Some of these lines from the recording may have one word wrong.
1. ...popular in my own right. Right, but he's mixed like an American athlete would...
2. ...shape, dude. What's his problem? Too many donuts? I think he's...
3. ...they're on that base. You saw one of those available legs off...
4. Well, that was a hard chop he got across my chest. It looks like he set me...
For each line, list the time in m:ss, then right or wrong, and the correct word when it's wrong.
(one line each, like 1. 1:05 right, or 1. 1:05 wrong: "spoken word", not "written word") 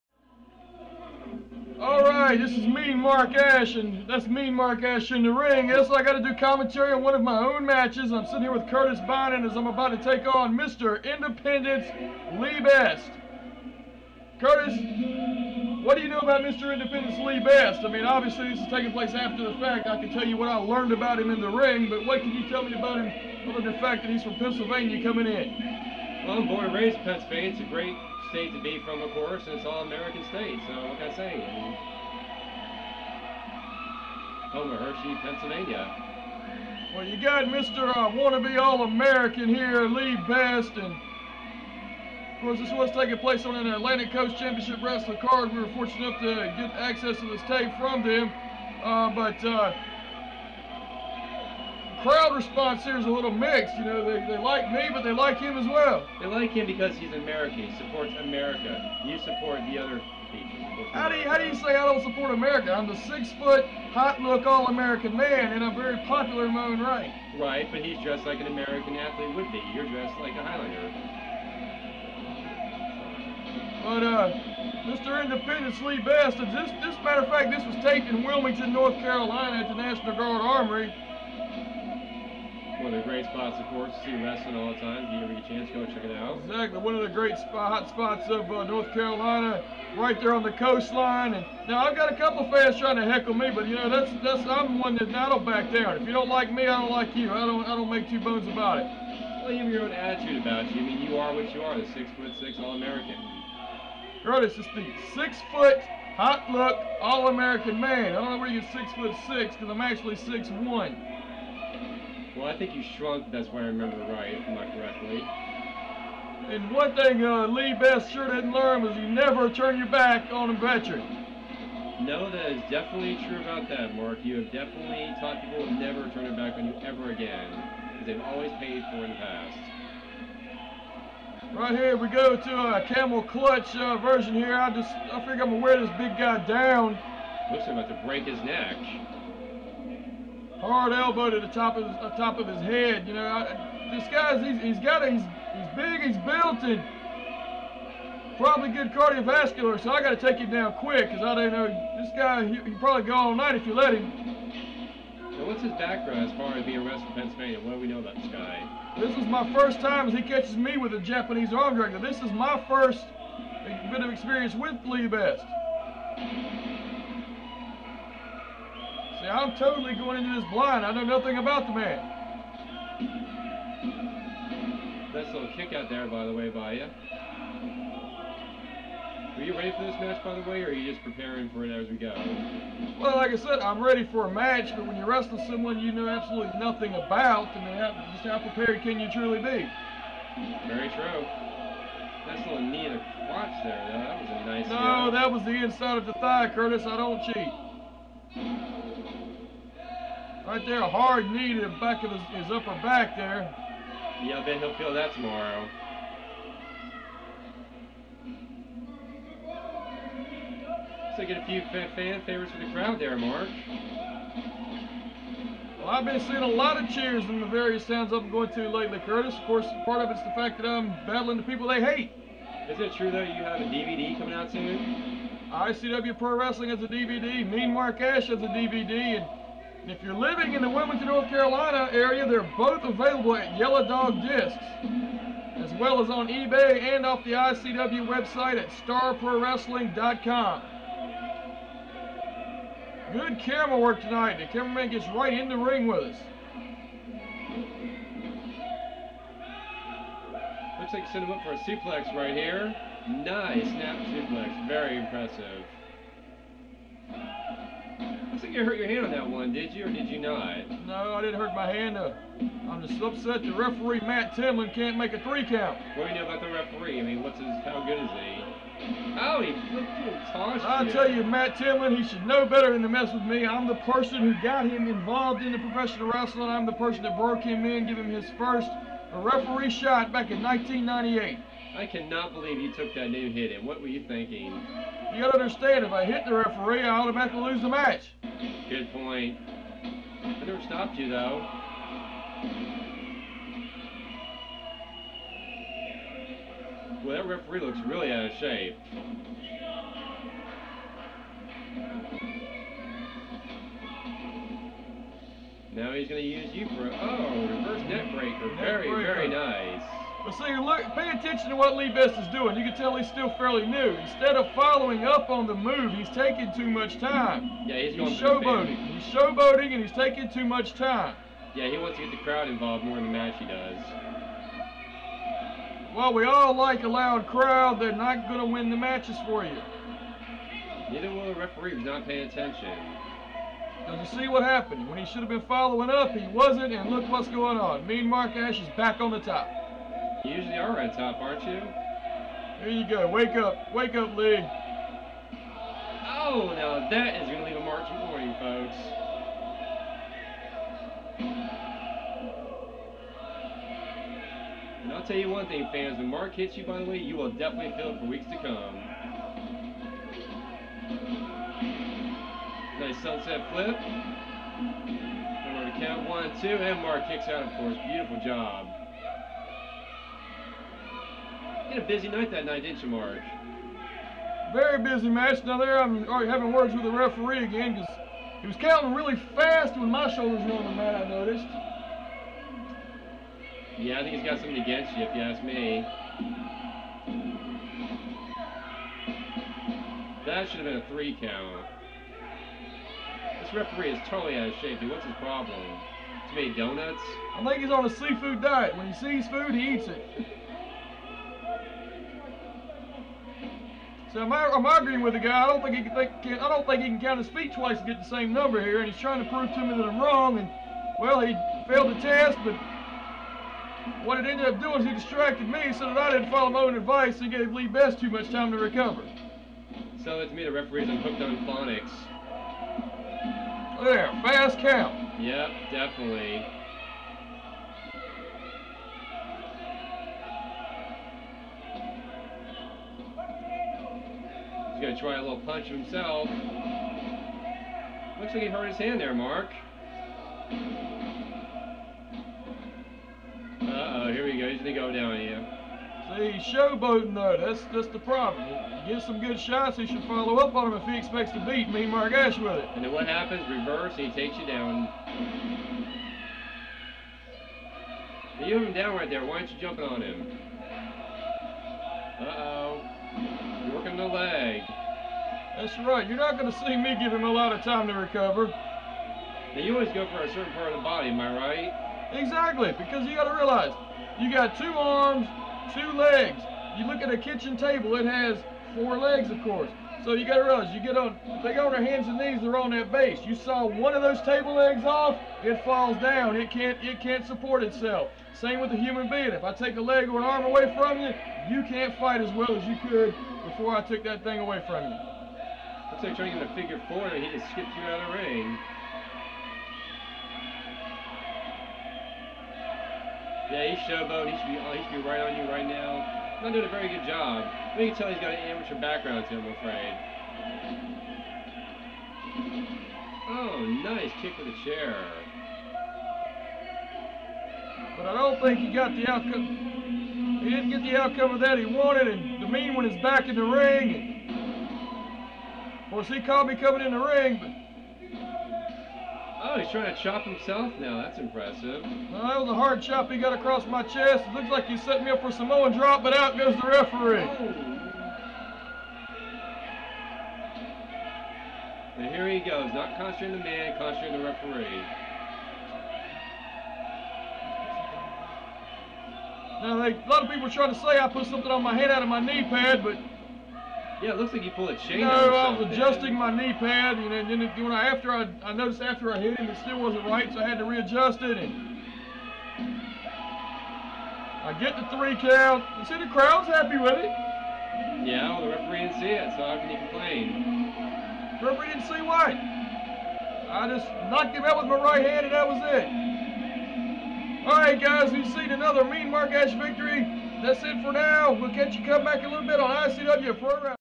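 1. 1:06 wrong: "dressed", not "mixed"
2. 6:34 right
3. 8:02 wrong: "table", not "available"
4. 8:52 right.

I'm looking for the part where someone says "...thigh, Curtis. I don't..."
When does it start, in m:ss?
3:16.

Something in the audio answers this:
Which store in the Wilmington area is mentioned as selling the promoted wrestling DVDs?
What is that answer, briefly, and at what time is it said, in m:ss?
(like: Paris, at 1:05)
Yellow Dog Discs, at 3:53.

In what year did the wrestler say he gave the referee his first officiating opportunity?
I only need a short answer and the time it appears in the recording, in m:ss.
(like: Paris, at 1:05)
1998, at 4:40.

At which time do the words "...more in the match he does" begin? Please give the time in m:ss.
5:22.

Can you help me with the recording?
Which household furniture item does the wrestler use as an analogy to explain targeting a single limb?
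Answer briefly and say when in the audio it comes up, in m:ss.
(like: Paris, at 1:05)
kitchen table, at 7:57.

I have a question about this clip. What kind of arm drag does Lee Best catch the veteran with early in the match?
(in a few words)
Japanese arm drag.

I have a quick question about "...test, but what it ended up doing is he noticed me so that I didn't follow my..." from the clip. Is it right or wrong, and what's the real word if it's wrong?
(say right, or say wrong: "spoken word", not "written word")
wrong: "distracted", not "noticed".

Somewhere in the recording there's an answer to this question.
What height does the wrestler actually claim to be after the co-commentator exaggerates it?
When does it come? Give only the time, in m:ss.
1:50.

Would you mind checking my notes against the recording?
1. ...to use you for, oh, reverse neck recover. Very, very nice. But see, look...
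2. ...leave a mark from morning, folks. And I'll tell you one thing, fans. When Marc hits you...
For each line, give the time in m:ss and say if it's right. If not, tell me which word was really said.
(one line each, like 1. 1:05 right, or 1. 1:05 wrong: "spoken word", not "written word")
1. 5:06 wrong: "breaker", not "recover"
2. 5:47 right.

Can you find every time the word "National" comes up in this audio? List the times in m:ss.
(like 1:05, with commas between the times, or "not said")
1:19.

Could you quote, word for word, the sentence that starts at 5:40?
You usually are on top, aren't you?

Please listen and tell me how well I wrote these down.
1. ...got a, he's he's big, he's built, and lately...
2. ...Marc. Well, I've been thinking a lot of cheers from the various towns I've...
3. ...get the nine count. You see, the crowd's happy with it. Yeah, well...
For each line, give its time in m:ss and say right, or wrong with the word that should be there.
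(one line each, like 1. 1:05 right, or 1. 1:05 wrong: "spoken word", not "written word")
1. 2:24 wrong: "probably", not "lately"
2. 3:33 wrong: "seeing", not "thinking"
3. 9:24 wrong: "three", not "nine".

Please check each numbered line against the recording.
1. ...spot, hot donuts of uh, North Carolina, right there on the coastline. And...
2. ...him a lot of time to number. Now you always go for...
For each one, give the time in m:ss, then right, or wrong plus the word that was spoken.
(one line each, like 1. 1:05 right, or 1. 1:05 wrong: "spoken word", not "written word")
1. 1:27 wrong: "spots", not "donuts"
2. 7:47 wrong: "recover", not "number".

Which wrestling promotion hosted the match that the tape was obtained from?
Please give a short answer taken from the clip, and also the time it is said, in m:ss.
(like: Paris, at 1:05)
Atlantic Coast Championship Wrestling, at 0:43.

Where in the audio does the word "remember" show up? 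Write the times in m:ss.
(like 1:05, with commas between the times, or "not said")
1:53, 6:05.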